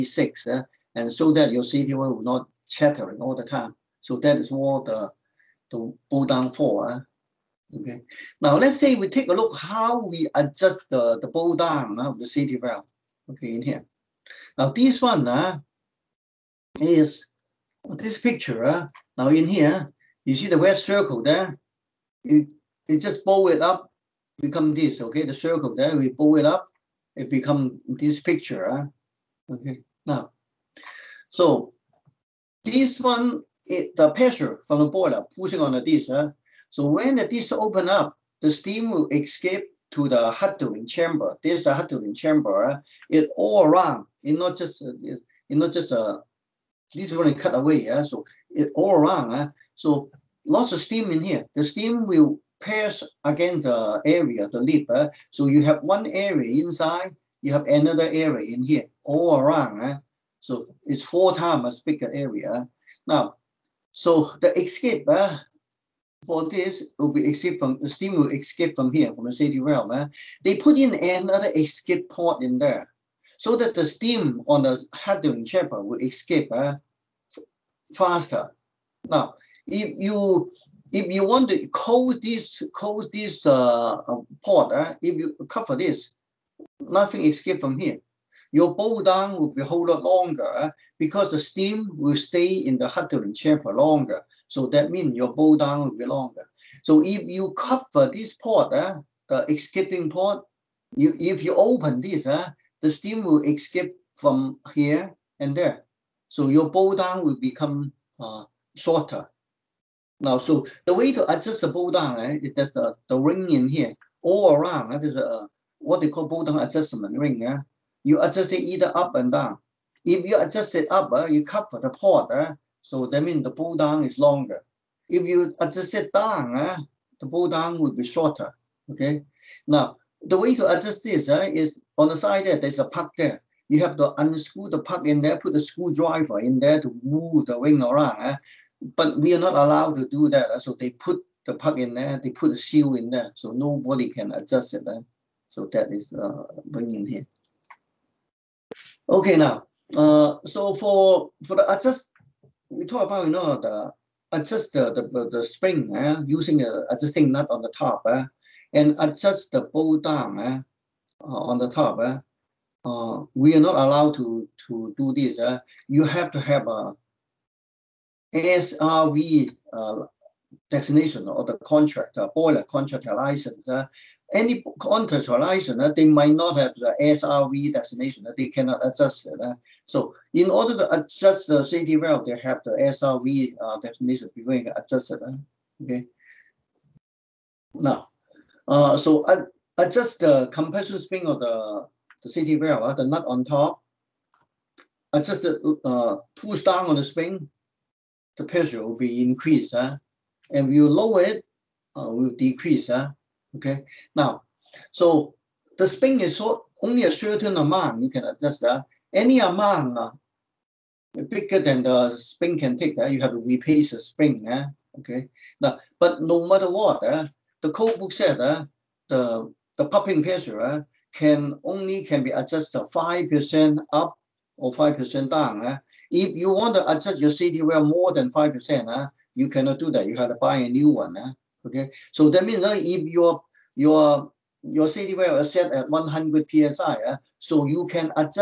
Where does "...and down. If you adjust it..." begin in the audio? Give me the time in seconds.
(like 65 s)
119 s.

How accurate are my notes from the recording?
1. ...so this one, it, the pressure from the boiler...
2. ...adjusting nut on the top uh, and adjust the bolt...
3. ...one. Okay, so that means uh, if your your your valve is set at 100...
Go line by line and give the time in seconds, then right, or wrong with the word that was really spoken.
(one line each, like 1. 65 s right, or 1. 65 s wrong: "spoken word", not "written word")
1. 31 s right
2. 156 s right
3. 230 s right.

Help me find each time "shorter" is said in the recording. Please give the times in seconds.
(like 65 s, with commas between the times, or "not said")
108 s, 128 s.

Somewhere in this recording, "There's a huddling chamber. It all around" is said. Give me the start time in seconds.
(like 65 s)
41 s.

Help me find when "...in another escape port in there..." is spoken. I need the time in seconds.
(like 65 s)
70 s.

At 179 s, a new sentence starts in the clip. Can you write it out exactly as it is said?
So in order to adjust the safety valve, they have the SRV uh, definition before you adjust it.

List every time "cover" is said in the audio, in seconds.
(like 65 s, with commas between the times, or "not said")
85 s, 97 s, 121 s.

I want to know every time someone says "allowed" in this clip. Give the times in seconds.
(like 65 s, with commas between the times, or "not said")
139 s, 163 s.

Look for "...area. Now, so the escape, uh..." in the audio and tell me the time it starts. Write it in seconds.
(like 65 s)
62 s.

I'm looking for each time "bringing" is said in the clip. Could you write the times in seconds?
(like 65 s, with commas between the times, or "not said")
146 s.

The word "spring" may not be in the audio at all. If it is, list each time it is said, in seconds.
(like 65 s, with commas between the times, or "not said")
155 s, 190 s, 197 s, 213 s.